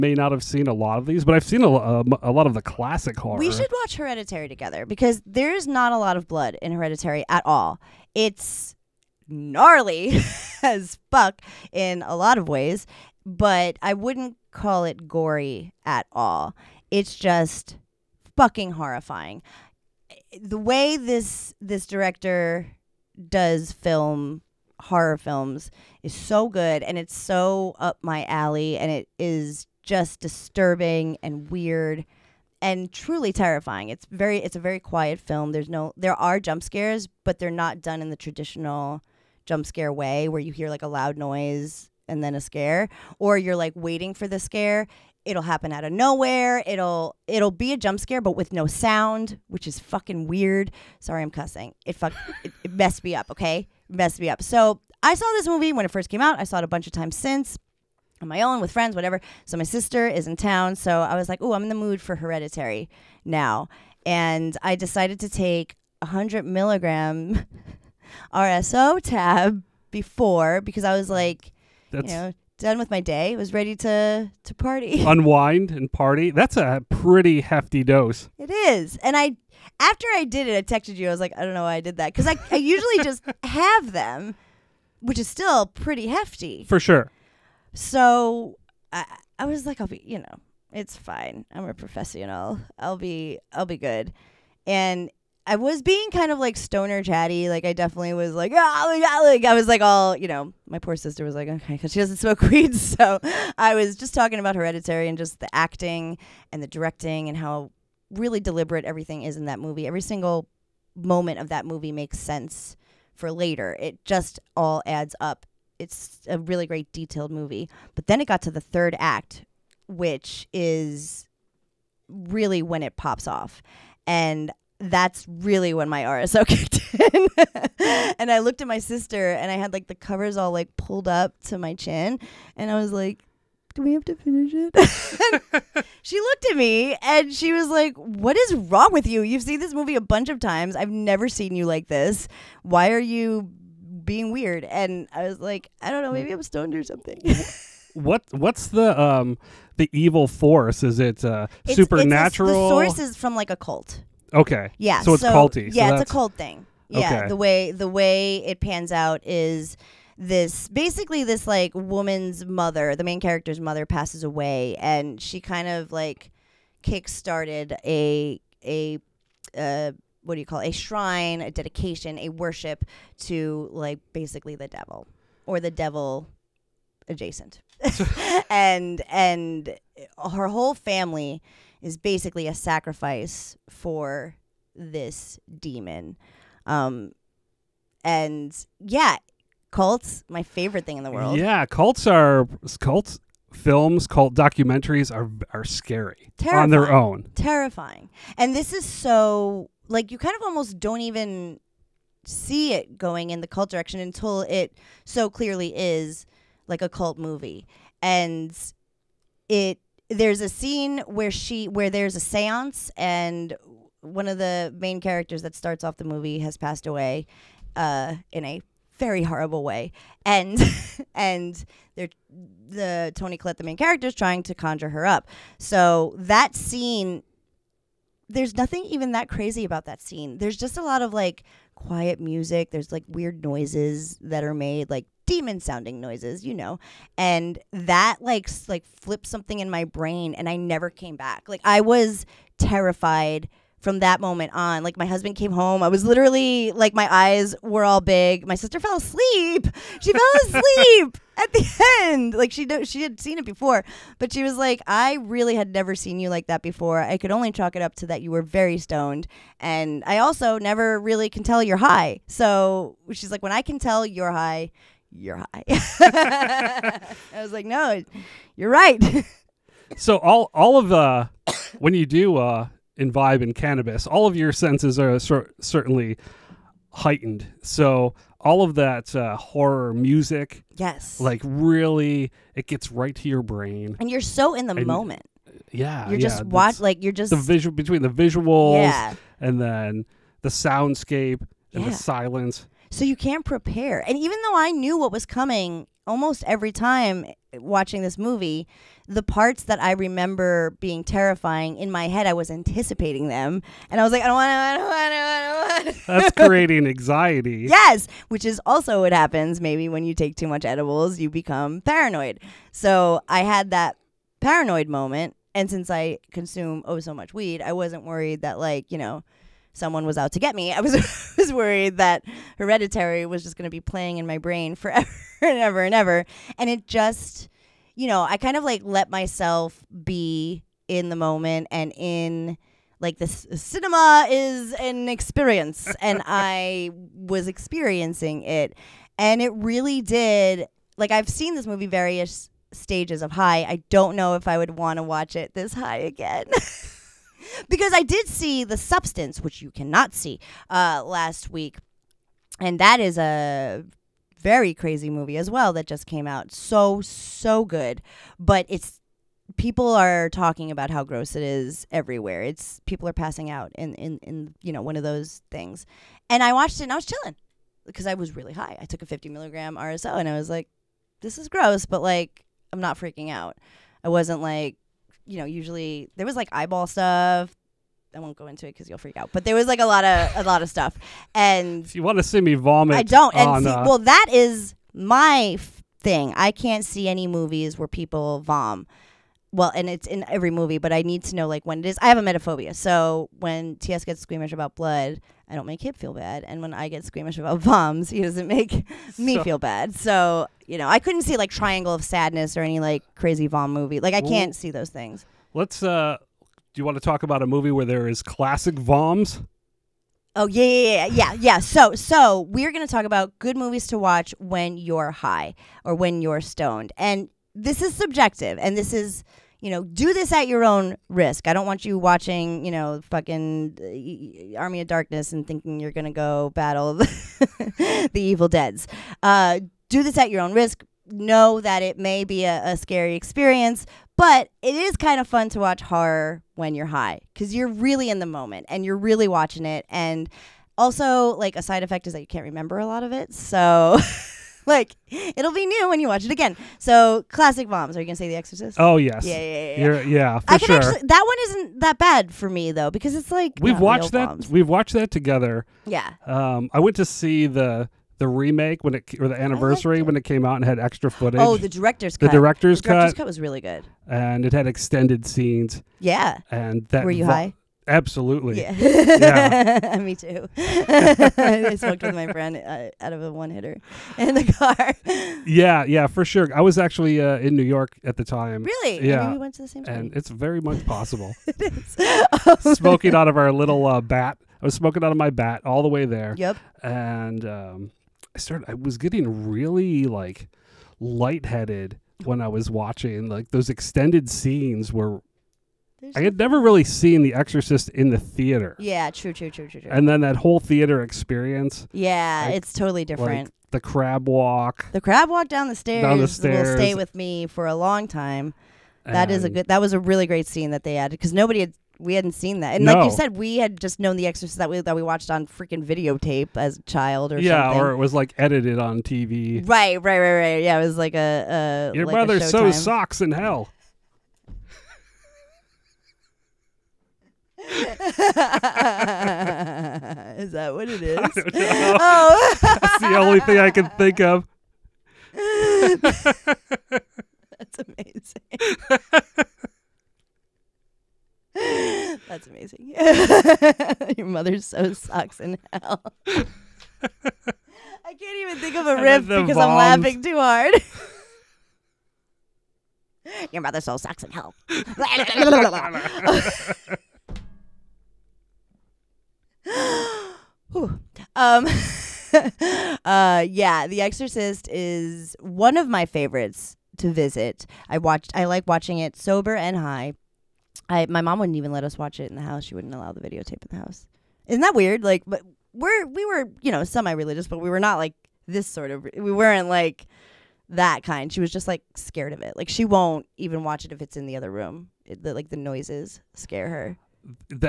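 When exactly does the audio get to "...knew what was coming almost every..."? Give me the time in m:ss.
4:54.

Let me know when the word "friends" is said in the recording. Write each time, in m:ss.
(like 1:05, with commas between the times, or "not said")
0:58, 7:52.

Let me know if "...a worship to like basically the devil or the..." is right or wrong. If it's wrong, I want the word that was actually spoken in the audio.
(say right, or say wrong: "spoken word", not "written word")
right.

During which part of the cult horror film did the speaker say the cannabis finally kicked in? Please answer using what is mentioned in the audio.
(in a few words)
The third act.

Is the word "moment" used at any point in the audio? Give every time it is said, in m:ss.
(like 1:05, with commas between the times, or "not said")
1:50, 4:04, 4:44, 5:14, 5:31, 7:18.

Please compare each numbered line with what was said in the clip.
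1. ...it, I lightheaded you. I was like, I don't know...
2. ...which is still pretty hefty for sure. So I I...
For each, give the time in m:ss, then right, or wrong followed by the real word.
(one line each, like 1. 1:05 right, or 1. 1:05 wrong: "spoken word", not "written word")
1. 1:20 wrong: "texted", not "lightheaded"
2. 1:25 right.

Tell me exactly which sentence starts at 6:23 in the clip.
And on, see, uh, well, that is my thing.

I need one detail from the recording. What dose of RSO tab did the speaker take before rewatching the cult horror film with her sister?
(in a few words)
100 milligrams.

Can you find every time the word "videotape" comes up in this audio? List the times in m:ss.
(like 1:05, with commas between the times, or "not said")
8:35, 9:33.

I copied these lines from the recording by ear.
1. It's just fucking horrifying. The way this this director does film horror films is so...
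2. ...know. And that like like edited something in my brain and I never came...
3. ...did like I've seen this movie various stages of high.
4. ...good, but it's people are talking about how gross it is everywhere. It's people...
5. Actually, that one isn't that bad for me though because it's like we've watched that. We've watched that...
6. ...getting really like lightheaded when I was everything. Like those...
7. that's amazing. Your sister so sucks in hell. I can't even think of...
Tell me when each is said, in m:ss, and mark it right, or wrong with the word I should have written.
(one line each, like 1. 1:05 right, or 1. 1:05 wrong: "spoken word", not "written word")
1. 0:16 right
2. 3:56 wrong: "flipped", not "edited"
3. 5:40 right
4. 5:57 right
5. 7:30 right
6. 8:08 wrong: "watching", not "everything"
7. 9:02 wrong: "mother", not "sister".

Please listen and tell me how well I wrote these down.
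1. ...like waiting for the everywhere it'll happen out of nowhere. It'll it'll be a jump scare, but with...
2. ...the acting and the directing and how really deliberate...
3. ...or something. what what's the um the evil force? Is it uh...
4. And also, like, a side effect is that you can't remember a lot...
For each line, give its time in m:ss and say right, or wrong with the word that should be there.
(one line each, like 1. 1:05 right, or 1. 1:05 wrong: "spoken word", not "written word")
1. 0:43 wrong: "scare", not "everywhere"
2. 1:45 right
3. 2:26 right
4. 7:19 right.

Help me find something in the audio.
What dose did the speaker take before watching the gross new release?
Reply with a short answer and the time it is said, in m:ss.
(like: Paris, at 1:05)
50 milligrams, at 6:09.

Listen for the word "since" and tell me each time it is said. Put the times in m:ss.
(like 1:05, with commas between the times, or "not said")
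0:57, 5:15.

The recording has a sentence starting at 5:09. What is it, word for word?
Maybe when you take too much edibles, you become paranoid.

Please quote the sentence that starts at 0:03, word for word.
We should watch Hereditary together because there's not a lot of blood in Hereditary at all.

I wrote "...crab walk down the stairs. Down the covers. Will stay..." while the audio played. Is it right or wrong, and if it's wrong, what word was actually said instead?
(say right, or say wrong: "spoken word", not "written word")
wrong: "stairs", not "covers".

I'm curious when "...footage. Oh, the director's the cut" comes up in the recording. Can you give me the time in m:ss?
7:41.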